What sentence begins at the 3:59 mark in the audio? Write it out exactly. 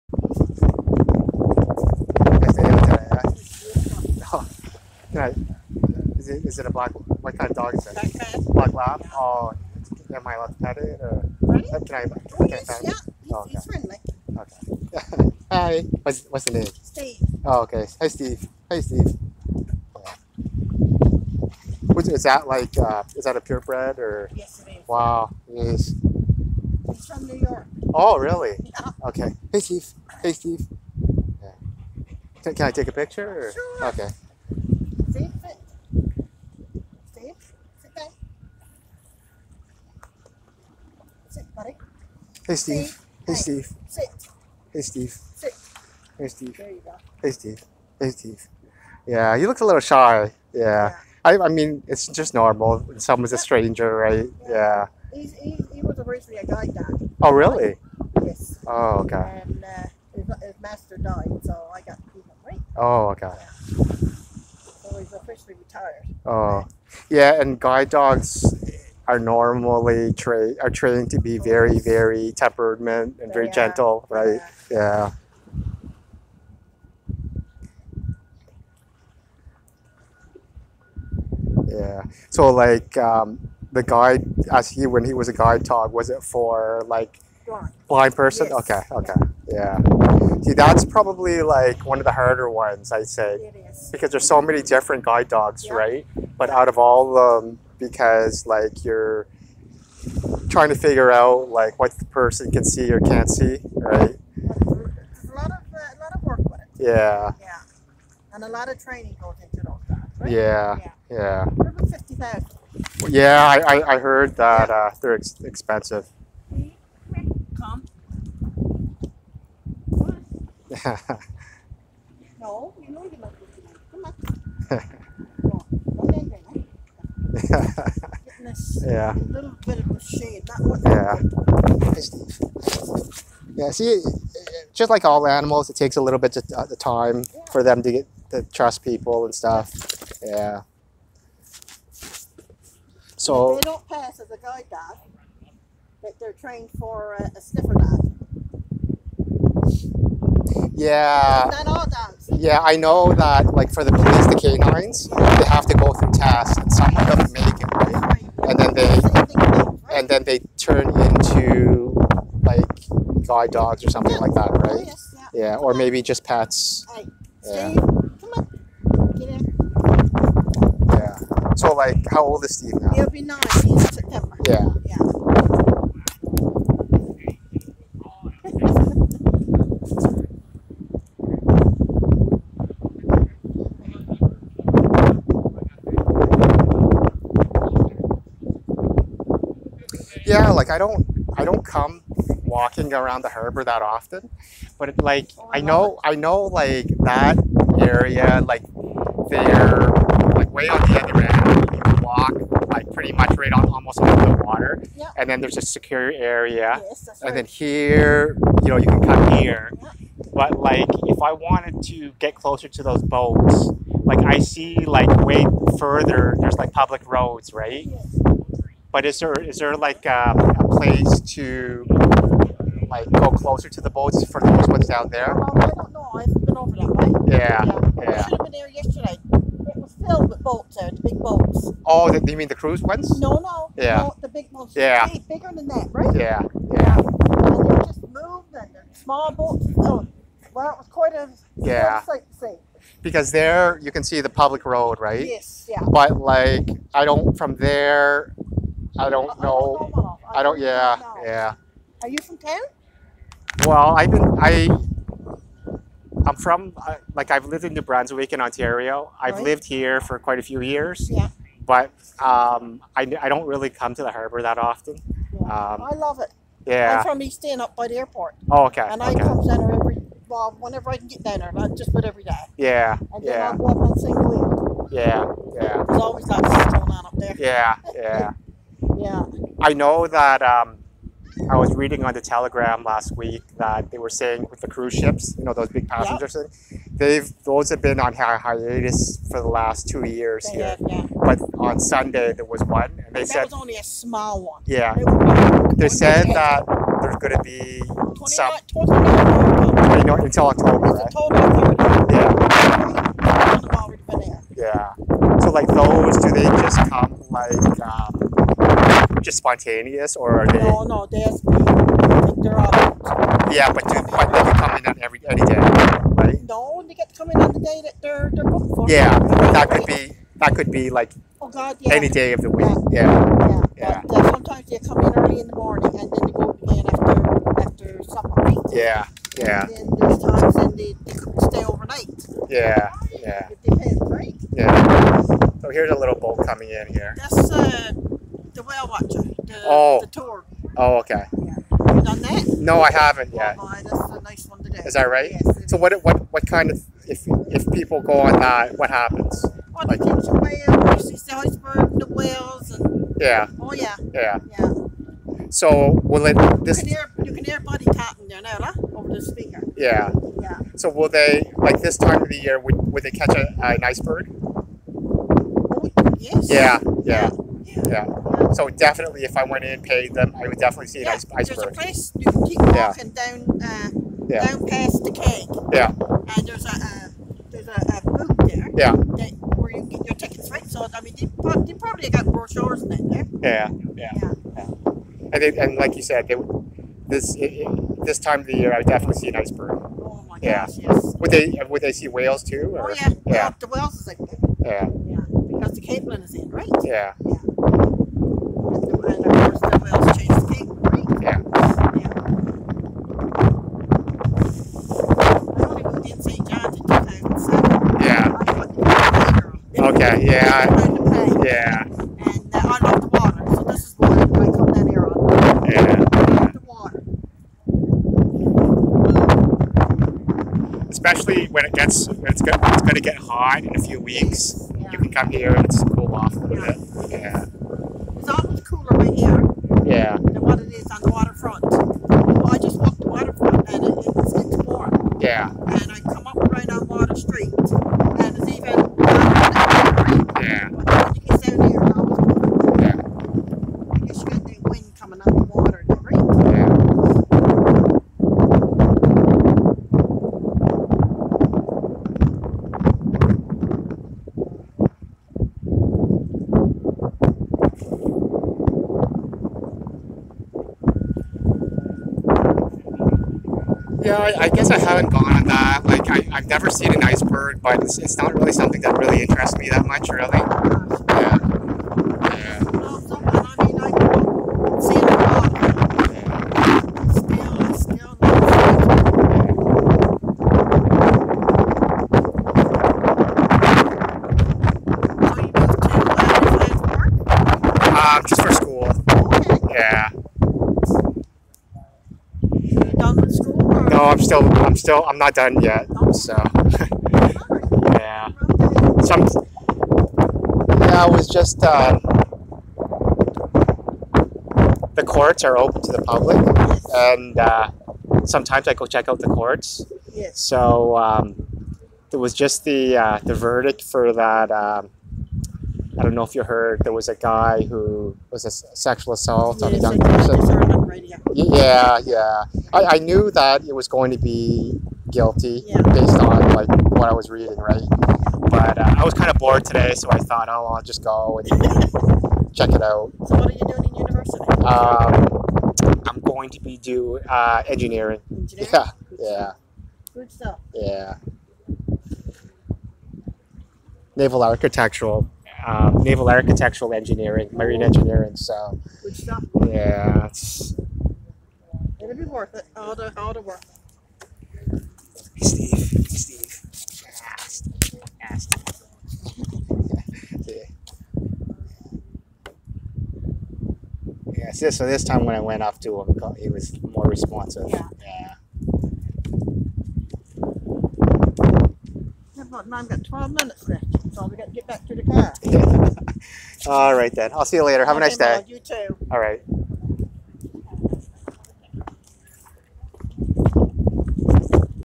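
Oh, well, it was quite a yeah.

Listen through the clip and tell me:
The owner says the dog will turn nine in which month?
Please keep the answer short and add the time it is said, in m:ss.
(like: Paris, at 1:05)
September, at 2:52.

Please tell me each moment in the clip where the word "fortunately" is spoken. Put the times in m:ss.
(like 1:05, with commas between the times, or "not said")
not said.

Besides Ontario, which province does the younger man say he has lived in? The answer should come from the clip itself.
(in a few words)
New Brunswick.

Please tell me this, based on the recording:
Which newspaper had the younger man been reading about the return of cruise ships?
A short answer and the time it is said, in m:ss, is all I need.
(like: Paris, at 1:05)
The Telegram, at 4:42.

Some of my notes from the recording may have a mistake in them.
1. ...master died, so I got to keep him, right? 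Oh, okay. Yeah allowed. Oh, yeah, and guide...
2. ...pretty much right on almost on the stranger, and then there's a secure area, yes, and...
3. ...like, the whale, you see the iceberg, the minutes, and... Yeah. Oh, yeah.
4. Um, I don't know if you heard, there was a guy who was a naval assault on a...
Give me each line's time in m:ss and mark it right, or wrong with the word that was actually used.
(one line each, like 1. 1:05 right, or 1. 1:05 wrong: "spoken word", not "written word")
1. 1:00 wrong: "tired", not "allowed"
2. 3:22 wrong: "water", not "stranger"
3. 5:49 wrong: "whales", not "minutes"
4. 8:34 wrong: "sexual", not "naval".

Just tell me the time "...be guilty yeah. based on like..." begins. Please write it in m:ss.
8:44.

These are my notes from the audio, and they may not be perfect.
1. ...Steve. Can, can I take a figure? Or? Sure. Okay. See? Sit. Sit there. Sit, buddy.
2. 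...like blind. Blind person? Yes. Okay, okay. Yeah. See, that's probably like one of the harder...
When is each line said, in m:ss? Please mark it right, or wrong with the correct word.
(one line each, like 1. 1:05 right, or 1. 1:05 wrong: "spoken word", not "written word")
1. 0:30 wrong: "picture", not "figure"
2. 1:26 right.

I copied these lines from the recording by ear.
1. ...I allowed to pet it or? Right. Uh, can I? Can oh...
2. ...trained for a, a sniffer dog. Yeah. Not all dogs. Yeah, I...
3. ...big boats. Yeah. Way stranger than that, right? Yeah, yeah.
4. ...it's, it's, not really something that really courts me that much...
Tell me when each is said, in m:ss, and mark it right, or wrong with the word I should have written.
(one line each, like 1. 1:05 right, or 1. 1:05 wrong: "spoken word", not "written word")
1. 0:10 right
2. 2:26 right
3. 3:54 wrong: "bigger", not "stranger"
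4. 7:47 wrong: "interests", not "courts".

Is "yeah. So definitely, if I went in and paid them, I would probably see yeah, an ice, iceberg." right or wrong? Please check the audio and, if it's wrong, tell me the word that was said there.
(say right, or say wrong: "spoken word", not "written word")
wrong: "definitely", not "probably".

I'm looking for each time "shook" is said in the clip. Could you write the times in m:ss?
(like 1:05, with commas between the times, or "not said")
not said.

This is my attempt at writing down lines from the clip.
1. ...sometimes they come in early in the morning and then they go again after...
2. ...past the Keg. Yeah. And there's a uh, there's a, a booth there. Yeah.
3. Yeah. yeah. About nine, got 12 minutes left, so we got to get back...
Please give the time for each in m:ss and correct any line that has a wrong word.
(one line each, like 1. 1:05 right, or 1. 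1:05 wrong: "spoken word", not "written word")
1. 5:24 right
2. 6:14 right
3. 9:27 right.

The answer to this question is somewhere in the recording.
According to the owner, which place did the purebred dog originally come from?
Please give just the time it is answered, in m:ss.
0:26.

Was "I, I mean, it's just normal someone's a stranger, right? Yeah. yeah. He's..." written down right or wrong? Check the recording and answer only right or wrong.
right.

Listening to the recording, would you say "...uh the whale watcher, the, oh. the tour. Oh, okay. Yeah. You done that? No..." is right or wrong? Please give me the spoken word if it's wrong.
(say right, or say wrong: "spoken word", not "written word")
right.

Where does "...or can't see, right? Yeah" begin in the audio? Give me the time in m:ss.
1:42.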